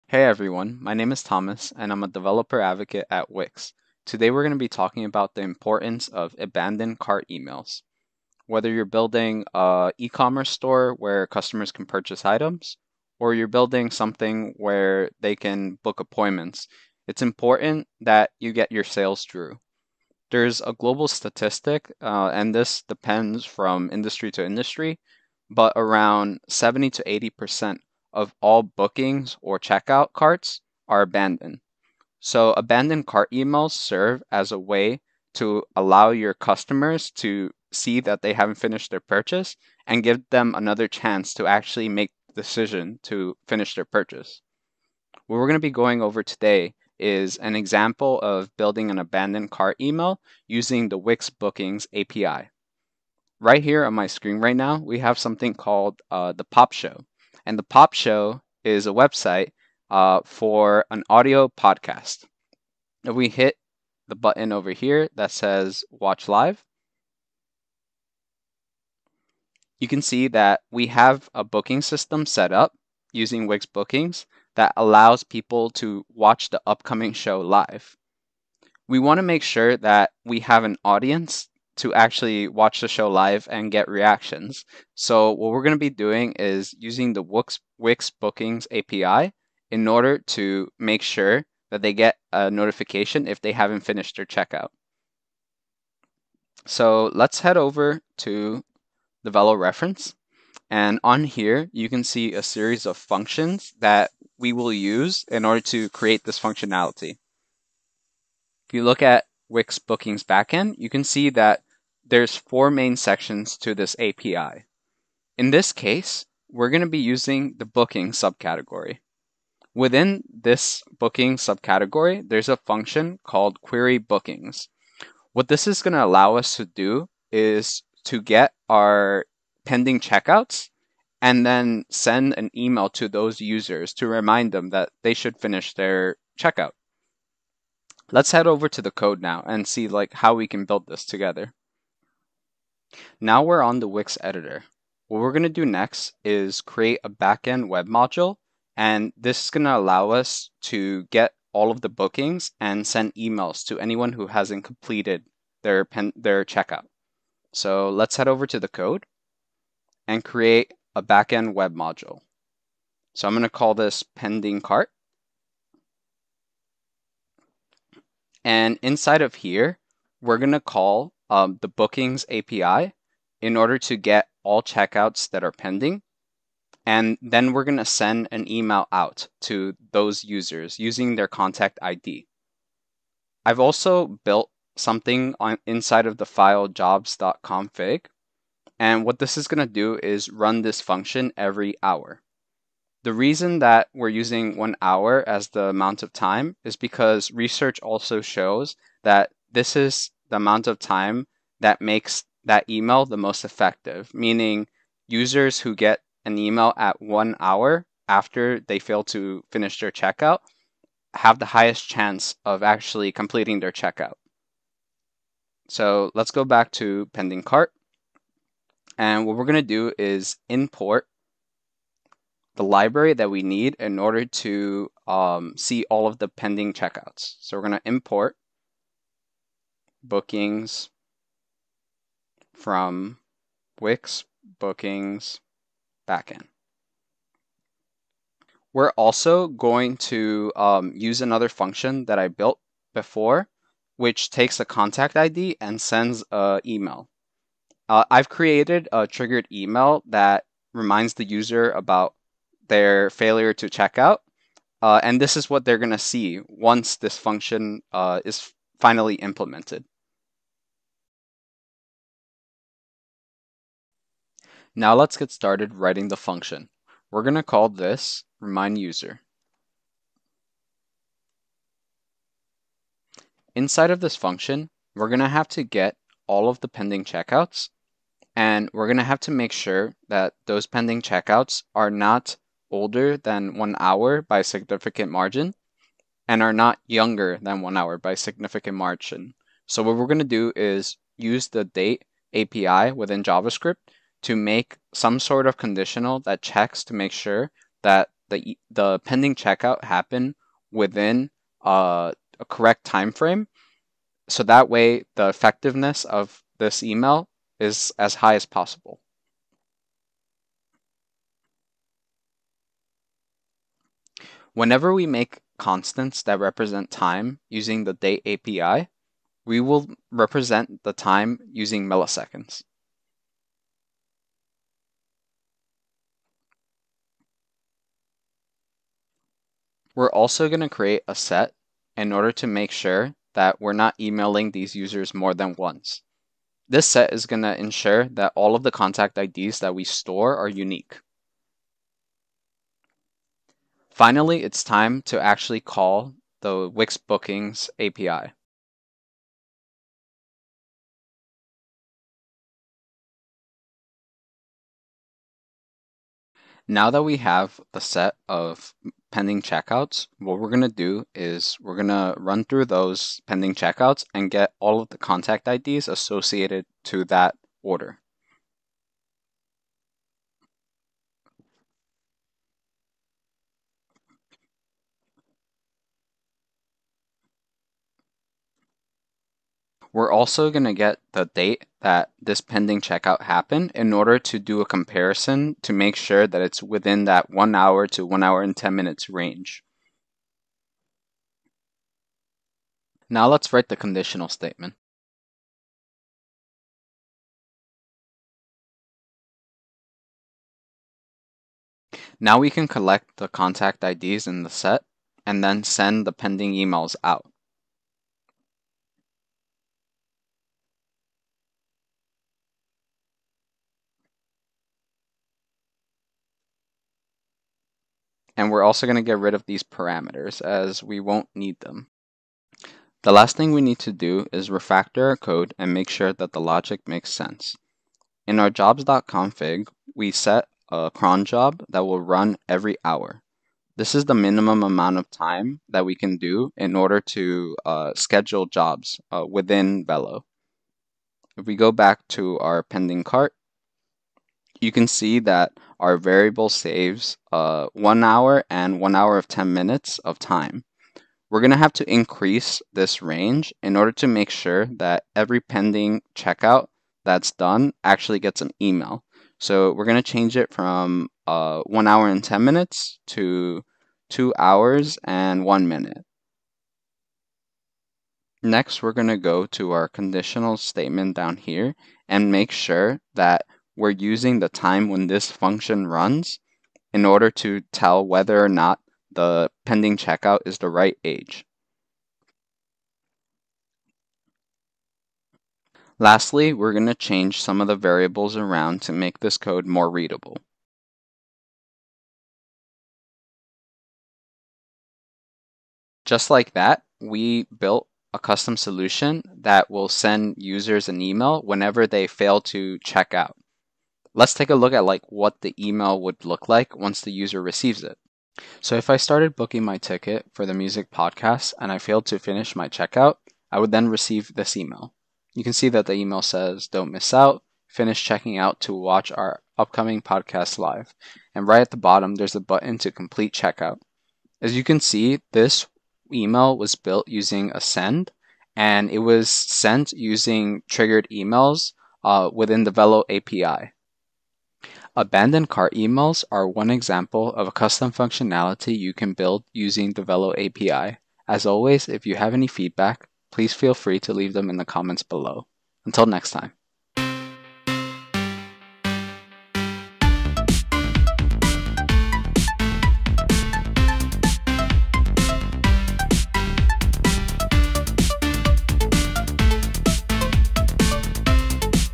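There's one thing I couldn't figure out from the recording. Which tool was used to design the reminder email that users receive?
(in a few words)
Ascend.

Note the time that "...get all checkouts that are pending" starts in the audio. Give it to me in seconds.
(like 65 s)
173 s.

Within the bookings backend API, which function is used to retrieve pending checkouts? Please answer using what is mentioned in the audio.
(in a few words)
query bookings.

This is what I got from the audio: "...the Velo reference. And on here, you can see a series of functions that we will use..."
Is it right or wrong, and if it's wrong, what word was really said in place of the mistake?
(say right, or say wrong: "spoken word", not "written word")
right.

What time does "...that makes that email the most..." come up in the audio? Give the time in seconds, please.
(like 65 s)
201 s.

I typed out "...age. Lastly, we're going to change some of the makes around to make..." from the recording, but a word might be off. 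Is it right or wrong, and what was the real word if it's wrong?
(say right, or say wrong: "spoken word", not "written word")
wrong: "variables", not "makes".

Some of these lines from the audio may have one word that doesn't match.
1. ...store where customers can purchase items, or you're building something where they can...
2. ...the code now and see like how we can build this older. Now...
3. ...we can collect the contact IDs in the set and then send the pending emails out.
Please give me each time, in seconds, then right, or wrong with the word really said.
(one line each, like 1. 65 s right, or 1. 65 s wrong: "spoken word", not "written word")
1. 10 s right
2. 138 s wrong: "together", not "older"
3. 402 s right.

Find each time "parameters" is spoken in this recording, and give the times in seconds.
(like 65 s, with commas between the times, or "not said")
419 s.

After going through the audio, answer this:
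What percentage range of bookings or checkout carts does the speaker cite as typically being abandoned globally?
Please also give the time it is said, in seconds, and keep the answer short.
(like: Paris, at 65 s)
70 to 80%, at 26 s.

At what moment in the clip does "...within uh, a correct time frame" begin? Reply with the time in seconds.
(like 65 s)
300 s.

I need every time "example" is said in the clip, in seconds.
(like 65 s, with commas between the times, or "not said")
47 s, 536 s.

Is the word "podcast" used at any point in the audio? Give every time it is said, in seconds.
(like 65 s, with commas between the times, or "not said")
61 s, 510 s, 520 s.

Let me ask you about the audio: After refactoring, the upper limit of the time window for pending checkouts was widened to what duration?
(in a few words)
two hours and one minute.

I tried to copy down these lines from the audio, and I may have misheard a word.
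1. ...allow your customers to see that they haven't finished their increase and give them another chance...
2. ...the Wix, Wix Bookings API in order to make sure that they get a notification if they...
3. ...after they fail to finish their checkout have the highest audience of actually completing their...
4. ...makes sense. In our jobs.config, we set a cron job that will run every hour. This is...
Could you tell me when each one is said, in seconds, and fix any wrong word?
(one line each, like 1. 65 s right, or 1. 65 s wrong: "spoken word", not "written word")
1. 35 s wrong: "purchase", not "increase"
2. 87 s right
3. 208 s wrong: "chance", not "audience"
4. 426 s right.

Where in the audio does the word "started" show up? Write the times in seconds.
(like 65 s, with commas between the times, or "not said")
265 s, 508 s.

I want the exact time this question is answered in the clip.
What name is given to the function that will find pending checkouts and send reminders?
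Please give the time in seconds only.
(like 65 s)
268 s.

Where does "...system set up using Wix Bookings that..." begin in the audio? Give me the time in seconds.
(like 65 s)
71 s.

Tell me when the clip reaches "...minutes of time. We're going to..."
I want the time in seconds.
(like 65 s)
449 s.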